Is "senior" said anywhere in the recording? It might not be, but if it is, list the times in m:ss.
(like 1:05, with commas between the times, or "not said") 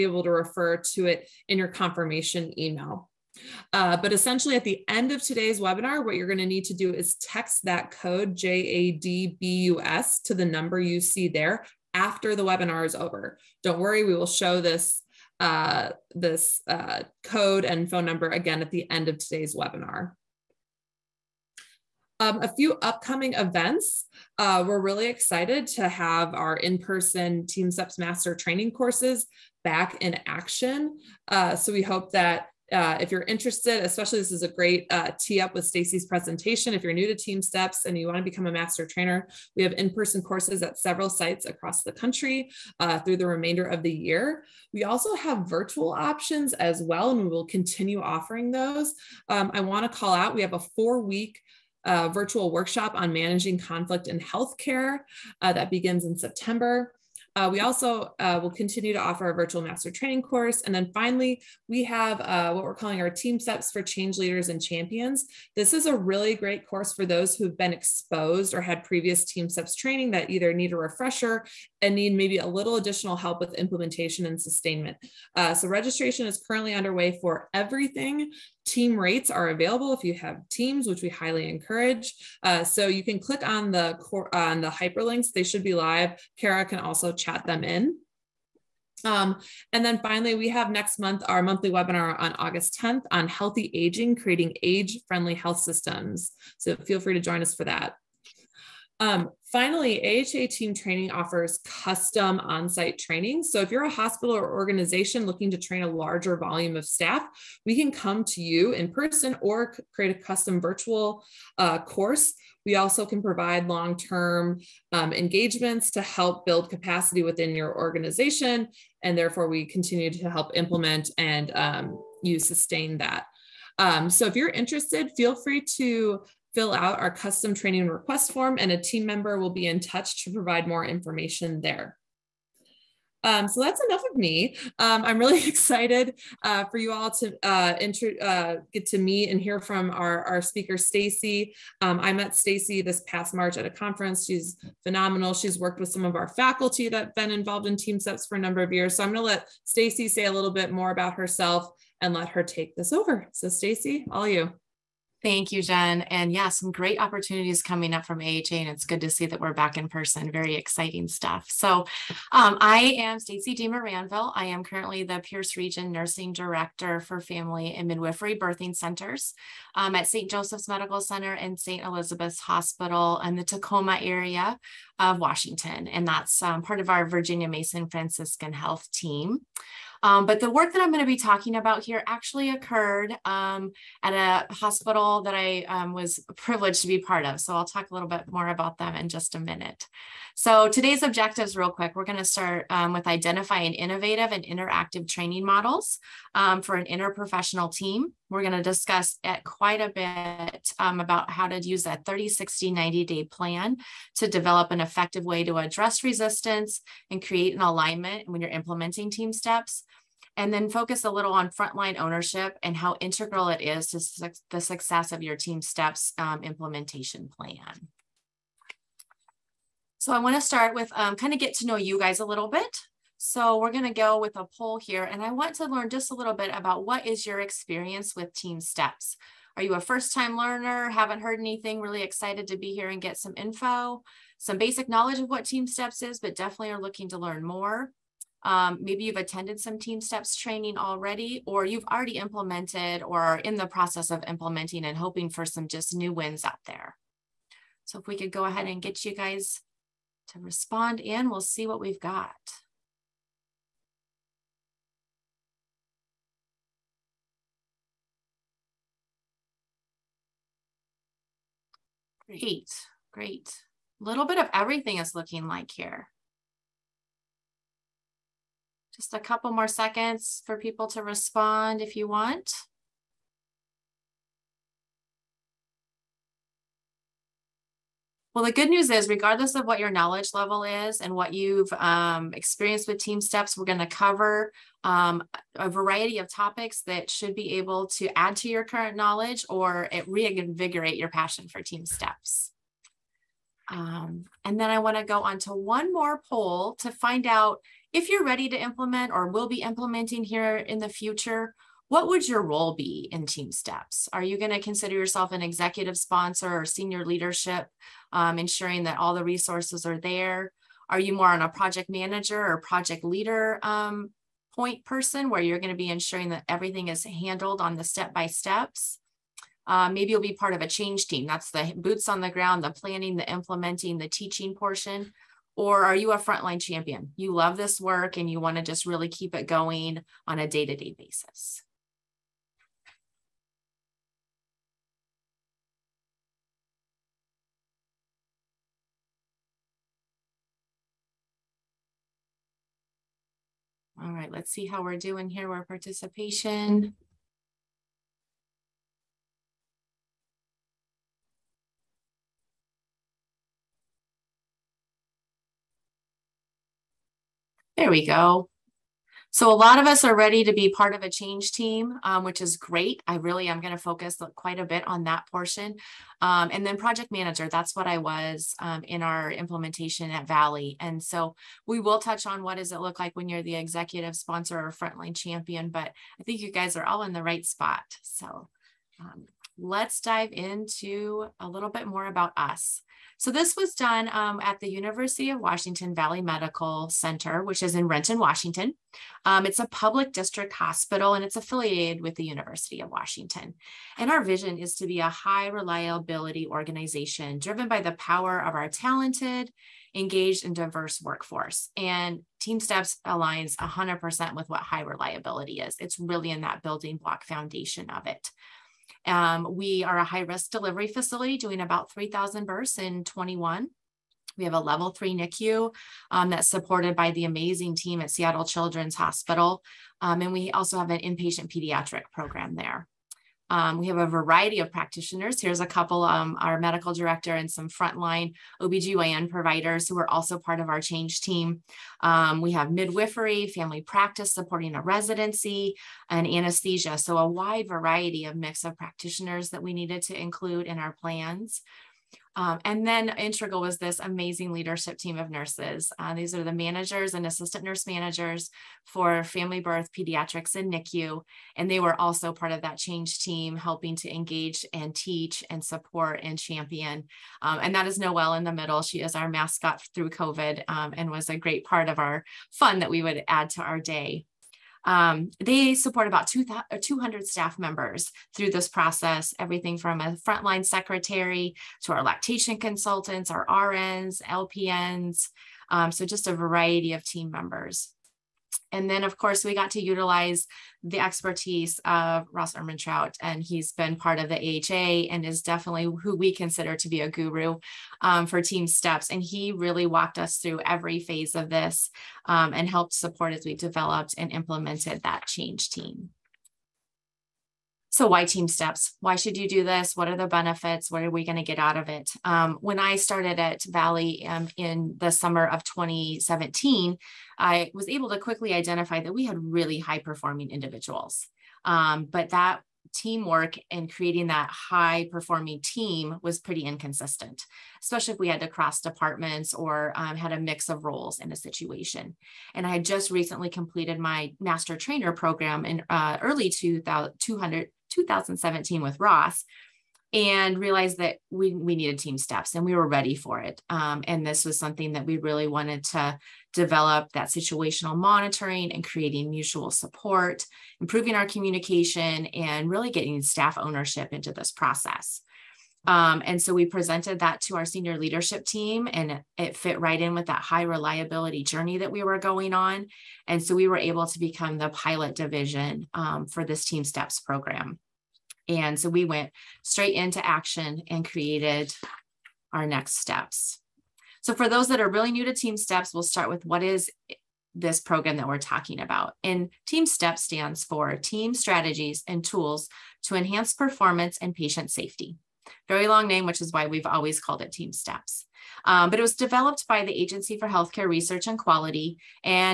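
5:06, 9:07.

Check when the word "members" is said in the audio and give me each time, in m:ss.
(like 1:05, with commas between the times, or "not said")
2:09, 7:47, 7:57.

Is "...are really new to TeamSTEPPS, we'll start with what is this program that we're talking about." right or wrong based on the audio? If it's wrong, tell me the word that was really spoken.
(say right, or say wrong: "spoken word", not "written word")
right.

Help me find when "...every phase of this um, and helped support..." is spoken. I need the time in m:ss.
8:10.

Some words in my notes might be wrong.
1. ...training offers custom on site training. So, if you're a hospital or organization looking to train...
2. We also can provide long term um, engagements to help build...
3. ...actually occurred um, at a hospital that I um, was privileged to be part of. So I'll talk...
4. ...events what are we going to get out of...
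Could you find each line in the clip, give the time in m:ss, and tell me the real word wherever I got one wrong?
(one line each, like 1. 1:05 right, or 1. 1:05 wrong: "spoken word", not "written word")
1. 1:40 right
2. 1:52 right
3. 3:02 right
4. 8:20 wrong: "benefits", not "events".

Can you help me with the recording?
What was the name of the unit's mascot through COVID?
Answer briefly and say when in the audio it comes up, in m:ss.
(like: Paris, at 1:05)
Noelle, at 7:37.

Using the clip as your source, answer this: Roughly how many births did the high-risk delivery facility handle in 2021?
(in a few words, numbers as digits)
3,000.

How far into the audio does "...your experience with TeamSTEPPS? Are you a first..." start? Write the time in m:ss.
3:47.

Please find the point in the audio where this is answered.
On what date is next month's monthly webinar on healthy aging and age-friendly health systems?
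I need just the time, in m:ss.
1:32.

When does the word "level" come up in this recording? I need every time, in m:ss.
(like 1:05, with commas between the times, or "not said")
4:40, 6:54.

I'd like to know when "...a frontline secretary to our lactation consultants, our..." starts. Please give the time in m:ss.
7:49.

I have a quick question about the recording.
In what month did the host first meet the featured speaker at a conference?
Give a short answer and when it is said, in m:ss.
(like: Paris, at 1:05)
March, at 2:23.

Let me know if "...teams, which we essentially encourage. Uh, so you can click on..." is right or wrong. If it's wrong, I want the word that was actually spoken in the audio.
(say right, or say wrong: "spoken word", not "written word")
wrong: "highly", not "essentially".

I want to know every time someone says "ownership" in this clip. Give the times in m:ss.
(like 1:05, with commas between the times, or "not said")
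3:31, 9:03.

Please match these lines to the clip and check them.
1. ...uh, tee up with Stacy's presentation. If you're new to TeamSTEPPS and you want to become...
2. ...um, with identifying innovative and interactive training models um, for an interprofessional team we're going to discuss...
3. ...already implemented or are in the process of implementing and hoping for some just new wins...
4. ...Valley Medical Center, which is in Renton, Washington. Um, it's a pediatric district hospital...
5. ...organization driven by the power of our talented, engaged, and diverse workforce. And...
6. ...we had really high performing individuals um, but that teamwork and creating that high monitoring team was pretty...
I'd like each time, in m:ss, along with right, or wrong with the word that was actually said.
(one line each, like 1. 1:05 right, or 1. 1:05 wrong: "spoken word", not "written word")
1. 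0:34 right
2. 3:12 right
3. 4:01 right
4. 6:25 wrong: "public", not "pediatric"
5. 6:36 right
6. 8:29 wrong: "performing", not "monitoring".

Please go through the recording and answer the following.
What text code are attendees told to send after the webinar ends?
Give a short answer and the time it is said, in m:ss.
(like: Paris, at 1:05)
JADBUS, at 0:08.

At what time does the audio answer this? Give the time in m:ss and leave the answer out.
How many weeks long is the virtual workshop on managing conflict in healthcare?
0:50.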